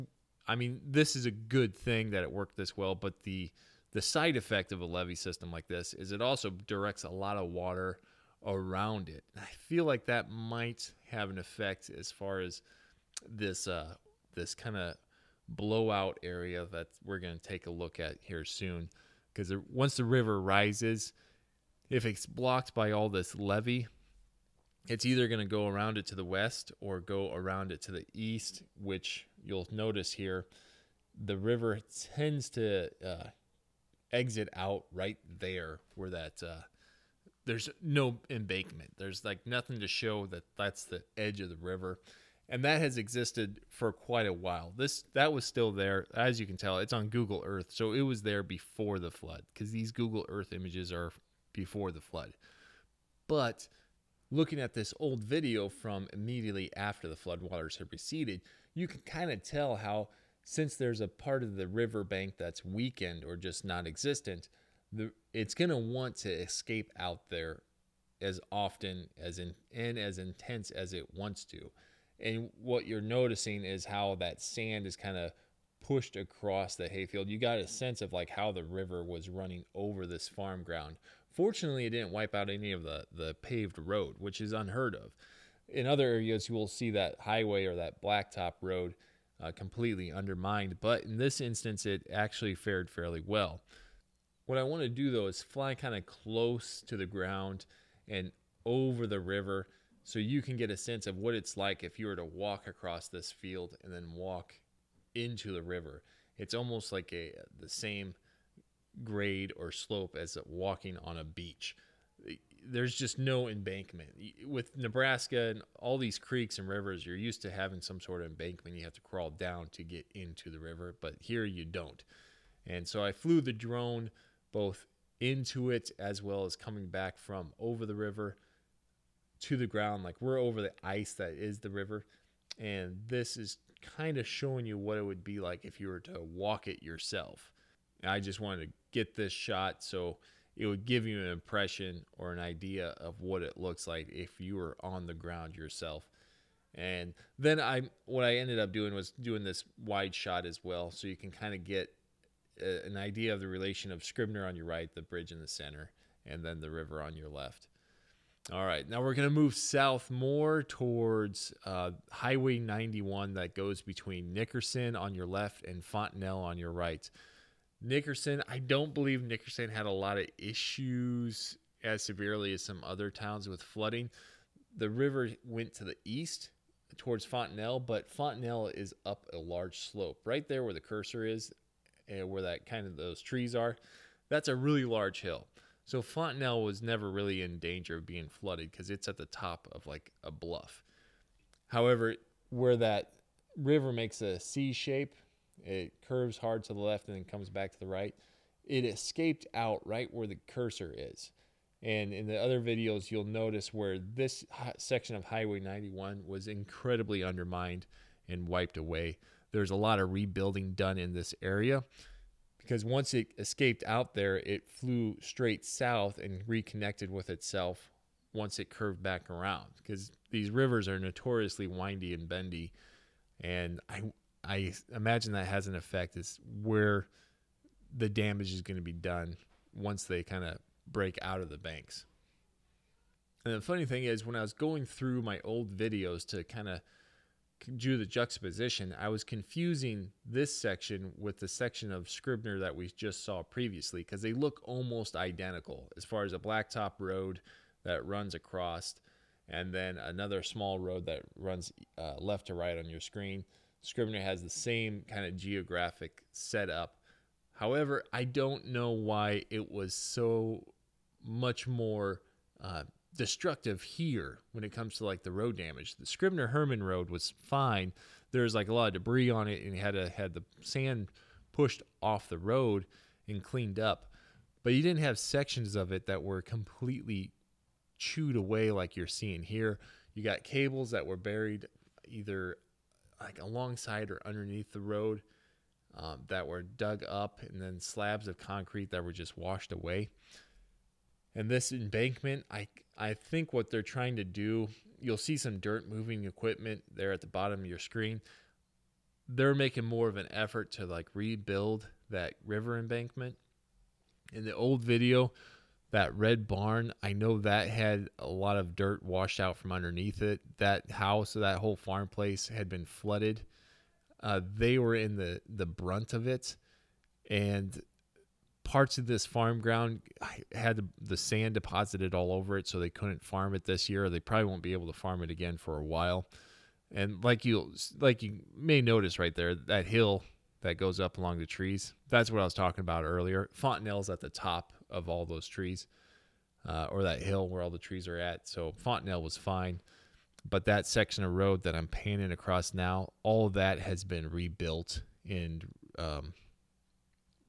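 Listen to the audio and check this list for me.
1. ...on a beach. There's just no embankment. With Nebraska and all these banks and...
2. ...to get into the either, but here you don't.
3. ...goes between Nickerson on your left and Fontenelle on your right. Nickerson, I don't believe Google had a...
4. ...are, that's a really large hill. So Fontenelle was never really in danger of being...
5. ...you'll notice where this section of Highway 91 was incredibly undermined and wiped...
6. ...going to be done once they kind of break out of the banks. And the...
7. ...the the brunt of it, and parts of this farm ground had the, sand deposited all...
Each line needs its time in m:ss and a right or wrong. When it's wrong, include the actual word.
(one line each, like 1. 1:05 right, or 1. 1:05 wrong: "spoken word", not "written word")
1. 1:51 wrong: "creeks", not "banks"
2. 1:59 wrong: "river", not "either"
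3. 2:43 wrong: "Nickerson", not "Google"
4. 3:03 right
5. 3:23 right
6. 3:48 right
7. 5:15 right.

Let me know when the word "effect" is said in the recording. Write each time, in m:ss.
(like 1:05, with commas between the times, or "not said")
0:04, 0:11, 3:45.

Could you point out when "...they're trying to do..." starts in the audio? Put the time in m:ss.
4:53.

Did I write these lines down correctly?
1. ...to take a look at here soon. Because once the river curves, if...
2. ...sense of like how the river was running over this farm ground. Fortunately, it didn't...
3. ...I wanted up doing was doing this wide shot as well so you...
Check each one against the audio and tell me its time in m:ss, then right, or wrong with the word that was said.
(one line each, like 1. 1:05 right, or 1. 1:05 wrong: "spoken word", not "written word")
1. 0:17 wrong: "rises", not "curves"
2. 1:17 right
3. 2:28 wrong: "ended", not "wanted".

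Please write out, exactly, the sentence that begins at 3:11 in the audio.
However, where that river makes a C shape, it curves hard to the left and then comes back to the right.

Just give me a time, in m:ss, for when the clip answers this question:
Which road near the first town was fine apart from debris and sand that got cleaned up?
4:26.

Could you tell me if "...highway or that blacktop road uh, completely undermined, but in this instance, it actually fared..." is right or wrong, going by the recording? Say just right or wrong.
right.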